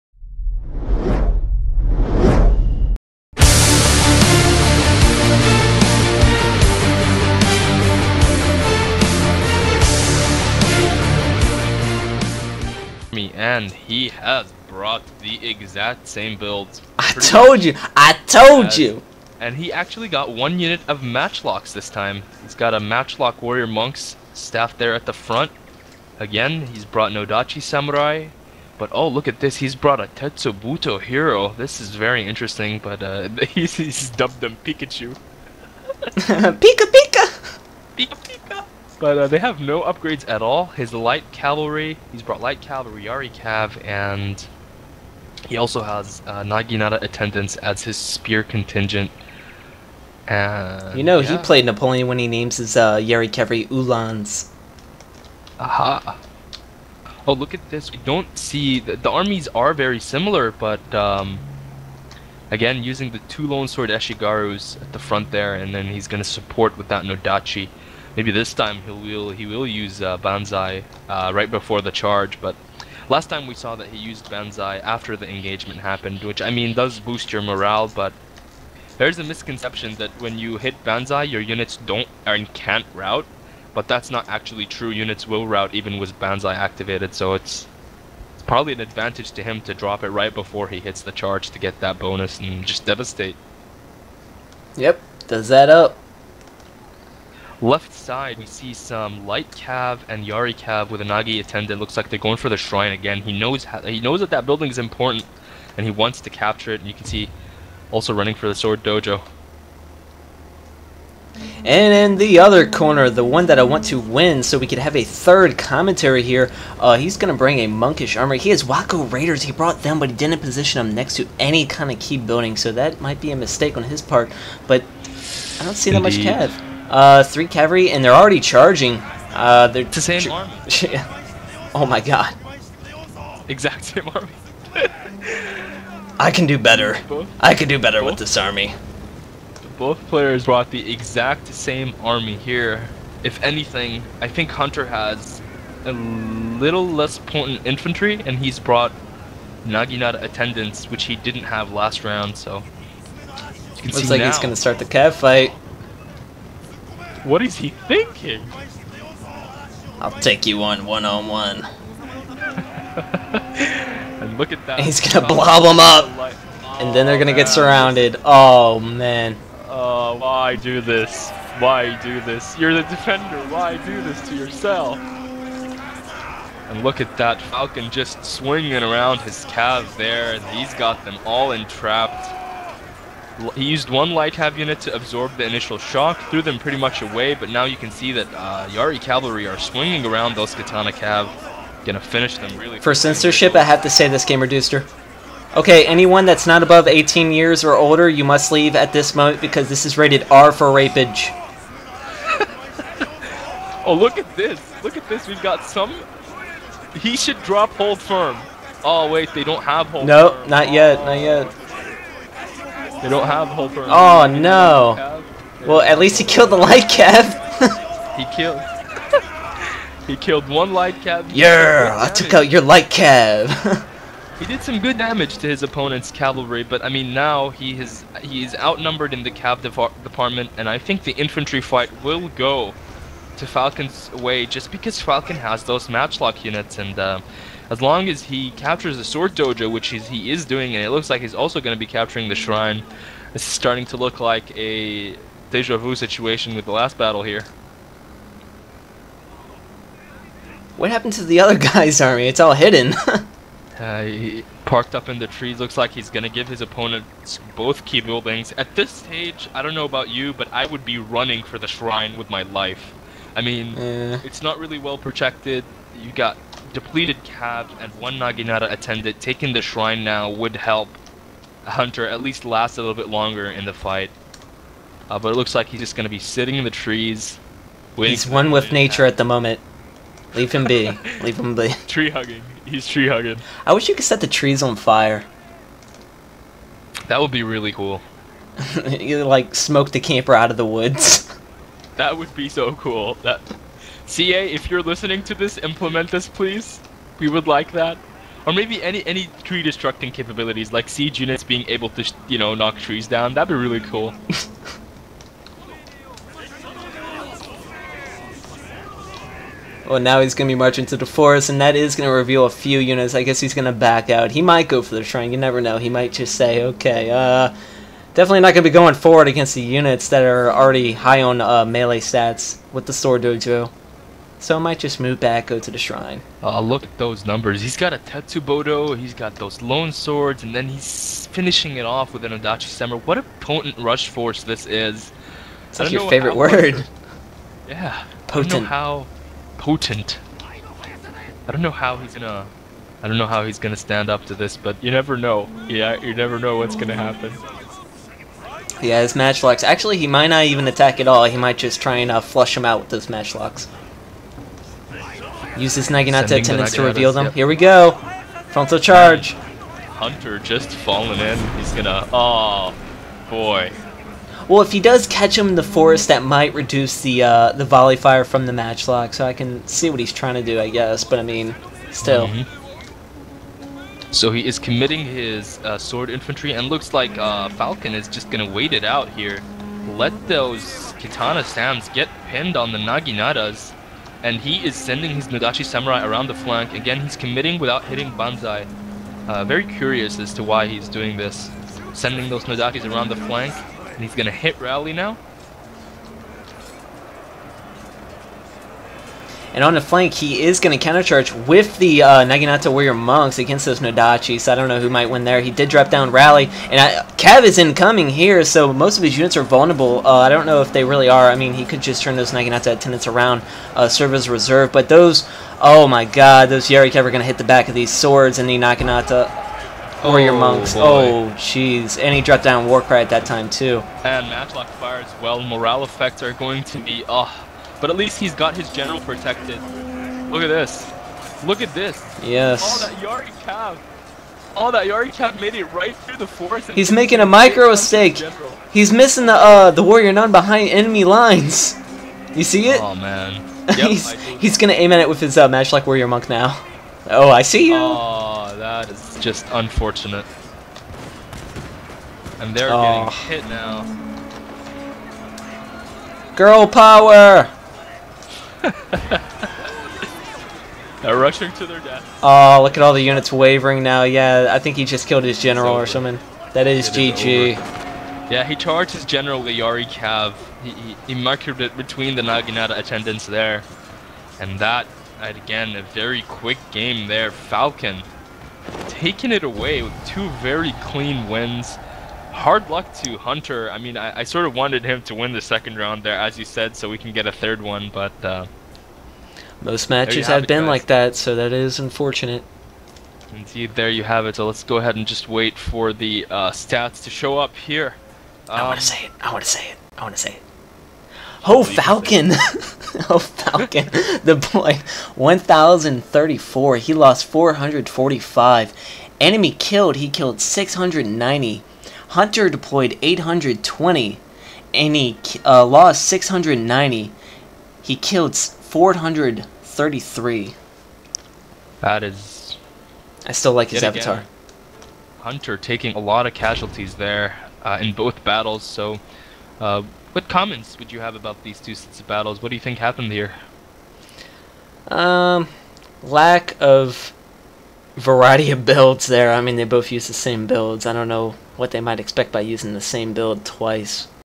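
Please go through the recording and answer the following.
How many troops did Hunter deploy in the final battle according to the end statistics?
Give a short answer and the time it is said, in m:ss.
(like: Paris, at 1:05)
820, at 8:33.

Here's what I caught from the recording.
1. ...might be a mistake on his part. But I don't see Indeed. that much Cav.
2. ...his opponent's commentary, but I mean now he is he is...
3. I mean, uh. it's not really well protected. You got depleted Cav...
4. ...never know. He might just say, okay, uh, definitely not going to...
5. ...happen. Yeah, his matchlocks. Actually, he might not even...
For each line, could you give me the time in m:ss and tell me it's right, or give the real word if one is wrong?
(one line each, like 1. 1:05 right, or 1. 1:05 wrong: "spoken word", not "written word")
1. 2:03 right
2. 3:45 wrong: "cavalry", not "commentary"
3. 4:23 right
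4. 5:15 right
5. 5:46 right.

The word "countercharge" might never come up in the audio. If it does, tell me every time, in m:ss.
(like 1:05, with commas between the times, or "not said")
6:40.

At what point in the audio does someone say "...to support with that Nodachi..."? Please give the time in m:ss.
1:06.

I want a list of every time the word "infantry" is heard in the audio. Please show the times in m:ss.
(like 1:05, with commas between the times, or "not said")
2:27, 3:51, 6:16.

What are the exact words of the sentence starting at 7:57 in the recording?
Falcon taking it away with two very clean wins hard luck to Hunter.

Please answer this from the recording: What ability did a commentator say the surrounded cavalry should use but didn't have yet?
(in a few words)
Hold firm.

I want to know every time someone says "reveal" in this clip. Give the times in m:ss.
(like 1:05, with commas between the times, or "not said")
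5:12, 5:56.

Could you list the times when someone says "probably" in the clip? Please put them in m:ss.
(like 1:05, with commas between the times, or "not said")
1:28.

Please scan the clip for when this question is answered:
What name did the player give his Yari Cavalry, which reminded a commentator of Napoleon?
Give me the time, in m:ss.
0:53.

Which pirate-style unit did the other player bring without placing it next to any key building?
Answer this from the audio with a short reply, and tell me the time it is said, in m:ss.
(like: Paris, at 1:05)
Wako Raiders, at 1:58.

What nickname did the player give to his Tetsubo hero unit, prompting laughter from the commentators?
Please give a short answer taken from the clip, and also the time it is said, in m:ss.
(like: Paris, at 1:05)
Pikachu, at 0:34.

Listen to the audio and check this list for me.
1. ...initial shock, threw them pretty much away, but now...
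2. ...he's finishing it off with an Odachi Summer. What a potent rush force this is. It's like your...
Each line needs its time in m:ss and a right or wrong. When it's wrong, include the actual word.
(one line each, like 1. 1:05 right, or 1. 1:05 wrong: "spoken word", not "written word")
1. 3:05 right
2. 5:30 right.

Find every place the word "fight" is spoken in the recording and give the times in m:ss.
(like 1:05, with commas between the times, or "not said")
2:35, 3:51, 4:33.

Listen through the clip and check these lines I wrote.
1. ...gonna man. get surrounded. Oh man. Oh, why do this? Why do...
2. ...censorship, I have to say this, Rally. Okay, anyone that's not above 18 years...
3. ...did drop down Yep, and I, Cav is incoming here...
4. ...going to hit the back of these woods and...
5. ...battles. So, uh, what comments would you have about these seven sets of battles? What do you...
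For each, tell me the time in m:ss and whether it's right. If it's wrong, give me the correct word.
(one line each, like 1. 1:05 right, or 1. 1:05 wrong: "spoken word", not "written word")
1. 2:47 right
2. 3:12 wrong: "Gamerdudester", not "Rally"
3. 6:45 wrong: "Rally", not "Yep"
4. 6:57 wrong: "swords", not "woods"
5. 8:48 wrong: "two", not "seven".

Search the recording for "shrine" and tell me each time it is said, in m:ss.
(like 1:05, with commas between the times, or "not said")
1:42, 4:02, 4:21, 4:29, 5:15, 5:25.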